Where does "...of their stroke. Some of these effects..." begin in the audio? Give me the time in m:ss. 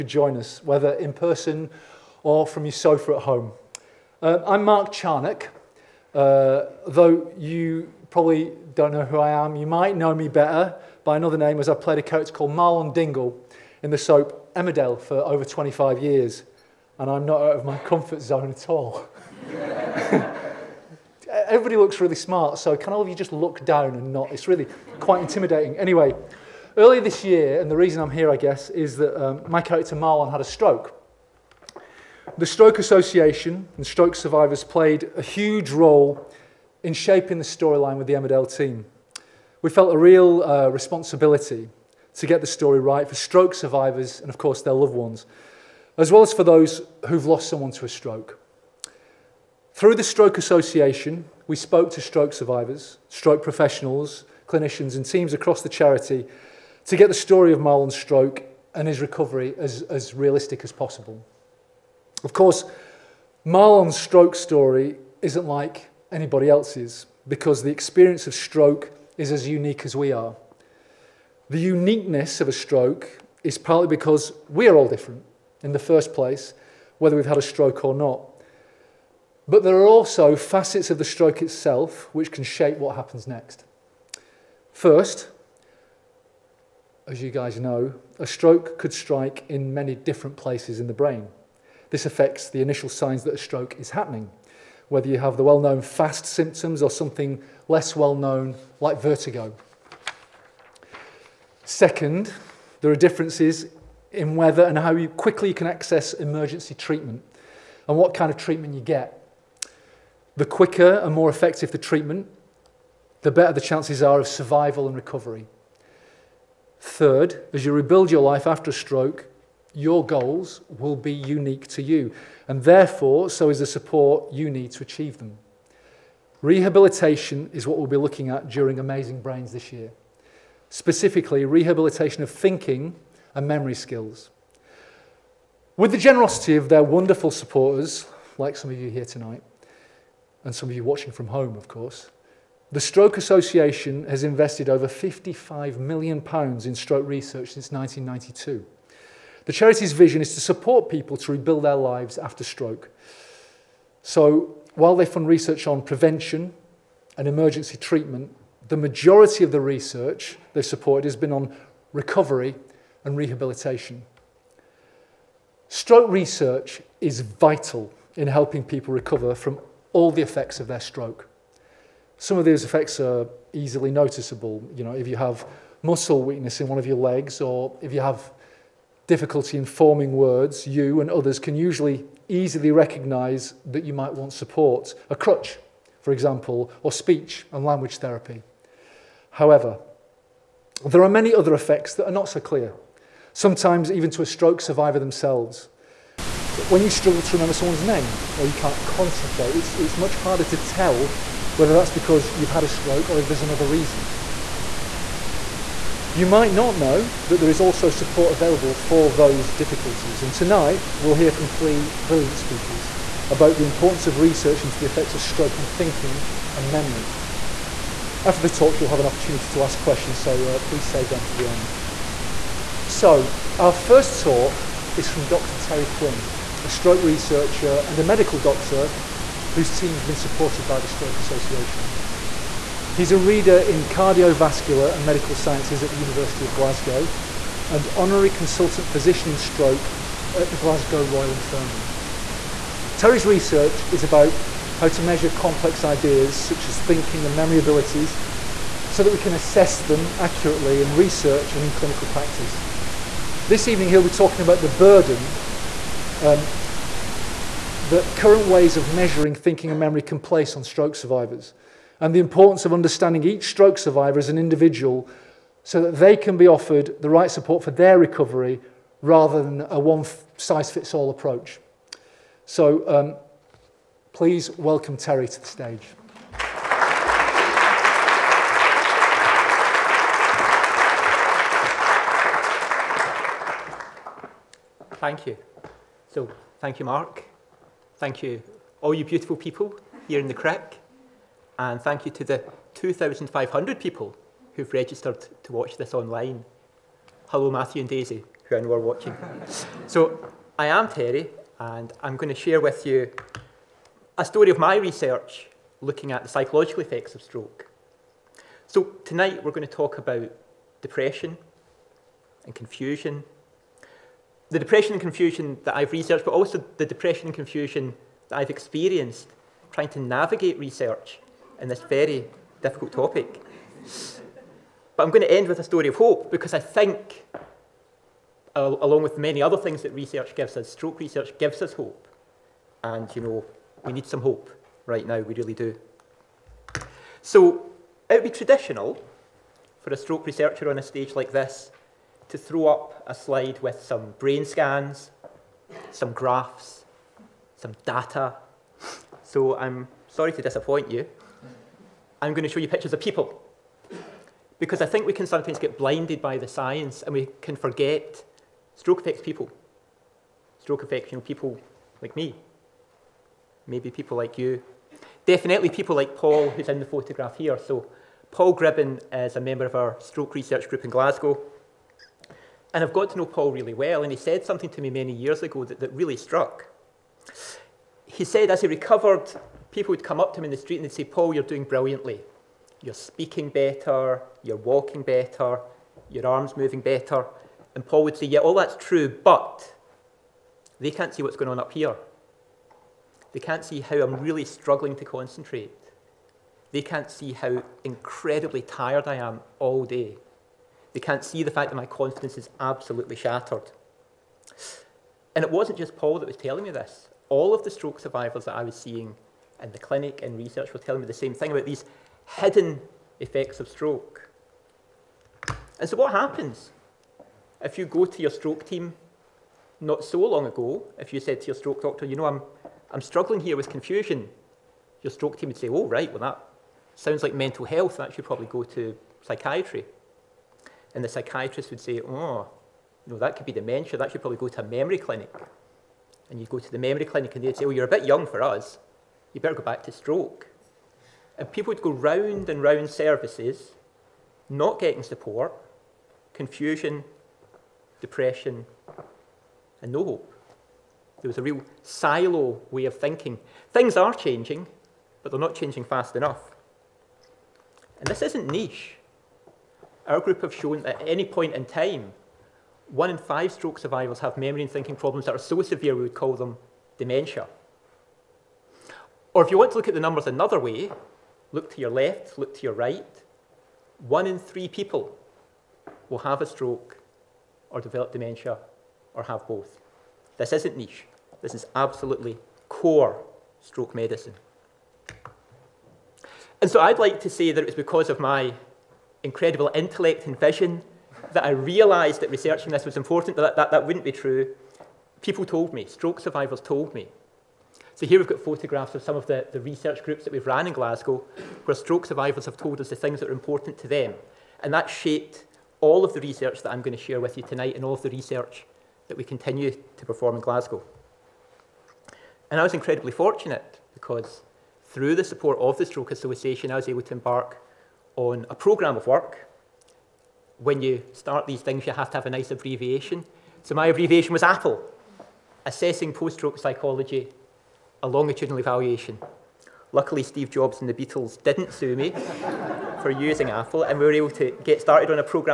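2:50.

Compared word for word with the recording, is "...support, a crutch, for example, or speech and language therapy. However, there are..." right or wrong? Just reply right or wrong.
right.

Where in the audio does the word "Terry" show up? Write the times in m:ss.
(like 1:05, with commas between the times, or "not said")
3:45, 4:02, 4:34, 5:00.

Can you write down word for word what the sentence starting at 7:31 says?
There was a real silo way of thinking.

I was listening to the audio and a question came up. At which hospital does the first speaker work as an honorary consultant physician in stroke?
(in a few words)
Glasgow Royal Infirmary.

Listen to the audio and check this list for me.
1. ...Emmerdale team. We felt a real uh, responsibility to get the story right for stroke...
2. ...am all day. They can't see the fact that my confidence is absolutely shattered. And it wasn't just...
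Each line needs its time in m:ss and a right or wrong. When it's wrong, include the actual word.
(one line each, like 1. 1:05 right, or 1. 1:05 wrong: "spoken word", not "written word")
1. 0:38 right
2. 6:39 right.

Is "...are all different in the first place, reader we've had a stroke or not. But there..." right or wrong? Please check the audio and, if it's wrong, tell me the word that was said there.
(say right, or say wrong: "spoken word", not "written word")
wrong: "whether", not "reader".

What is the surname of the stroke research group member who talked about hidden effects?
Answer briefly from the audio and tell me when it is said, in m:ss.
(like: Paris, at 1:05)
Gribben, at 6:08.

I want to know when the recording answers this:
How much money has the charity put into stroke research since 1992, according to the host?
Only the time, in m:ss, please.
2:24.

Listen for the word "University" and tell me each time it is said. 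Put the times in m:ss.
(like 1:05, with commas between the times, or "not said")
3:55.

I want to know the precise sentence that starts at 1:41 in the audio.
Second, there are differences in whether and how you quickly you can access emergency treatment and what kind of treatment you get.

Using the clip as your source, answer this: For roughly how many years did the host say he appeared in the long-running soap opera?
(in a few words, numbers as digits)
25.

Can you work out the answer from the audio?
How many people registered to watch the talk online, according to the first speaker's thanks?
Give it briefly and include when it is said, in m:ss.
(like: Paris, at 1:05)
2,500, at 4:52.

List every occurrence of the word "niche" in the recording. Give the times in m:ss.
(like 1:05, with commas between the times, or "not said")
7:38, 8:00.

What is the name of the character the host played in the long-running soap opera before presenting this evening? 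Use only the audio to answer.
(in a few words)
Marlon Dingle.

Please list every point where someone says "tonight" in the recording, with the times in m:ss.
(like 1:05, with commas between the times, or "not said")
2:19, 3:30, 5:09, 8:27.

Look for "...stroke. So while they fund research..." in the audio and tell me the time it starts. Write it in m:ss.
2:32.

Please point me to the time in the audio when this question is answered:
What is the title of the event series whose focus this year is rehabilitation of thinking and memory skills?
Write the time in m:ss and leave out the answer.
2:08.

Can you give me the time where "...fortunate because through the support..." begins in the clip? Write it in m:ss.
8:33.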